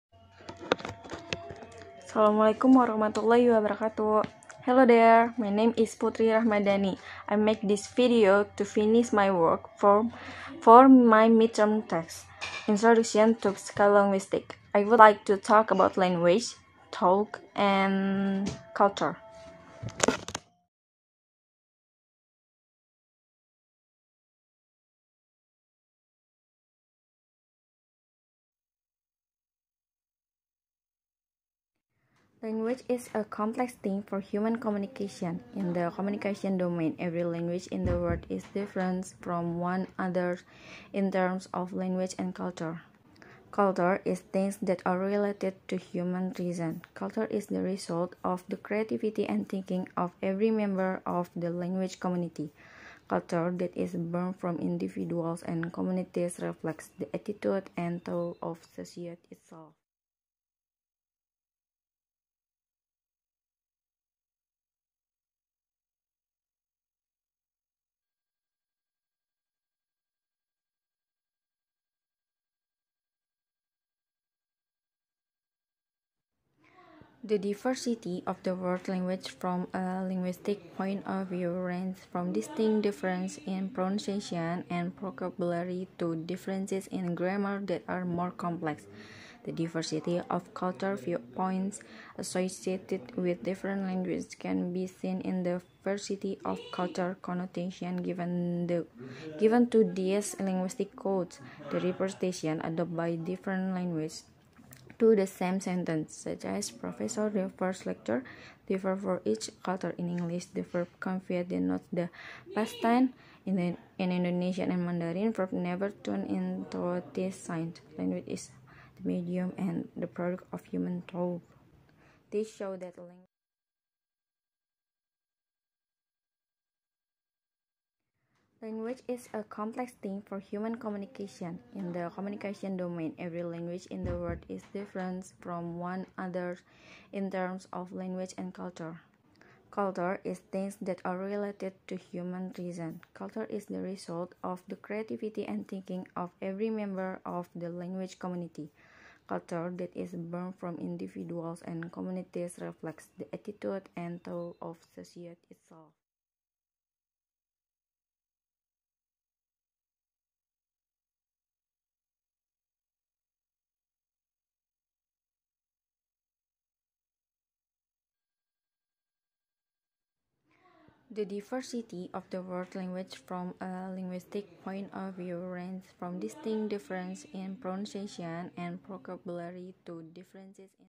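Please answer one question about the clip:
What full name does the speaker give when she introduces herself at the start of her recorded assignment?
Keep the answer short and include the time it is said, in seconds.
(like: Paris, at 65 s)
Putri Rahmadani, at 5 s.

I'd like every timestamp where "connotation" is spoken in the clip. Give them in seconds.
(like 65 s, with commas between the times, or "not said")
97 s.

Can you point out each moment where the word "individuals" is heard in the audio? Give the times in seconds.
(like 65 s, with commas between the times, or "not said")
54 s, 150 s.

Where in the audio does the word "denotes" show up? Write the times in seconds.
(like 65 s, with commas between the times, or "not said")
111 s.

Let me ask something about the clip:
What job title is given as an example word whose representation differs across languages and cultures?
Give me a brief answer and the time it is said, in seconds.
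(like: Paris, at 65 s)
professor, at 106 s.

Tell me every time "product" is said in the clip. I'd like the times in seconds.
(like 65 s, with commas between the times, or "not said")
120 s.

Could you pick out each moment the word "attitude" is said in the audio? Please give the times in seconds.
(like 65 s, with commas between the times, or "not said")
57 s, 153 s.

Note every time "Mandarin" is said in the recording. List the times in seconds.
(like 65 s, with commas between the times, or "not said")
114 s.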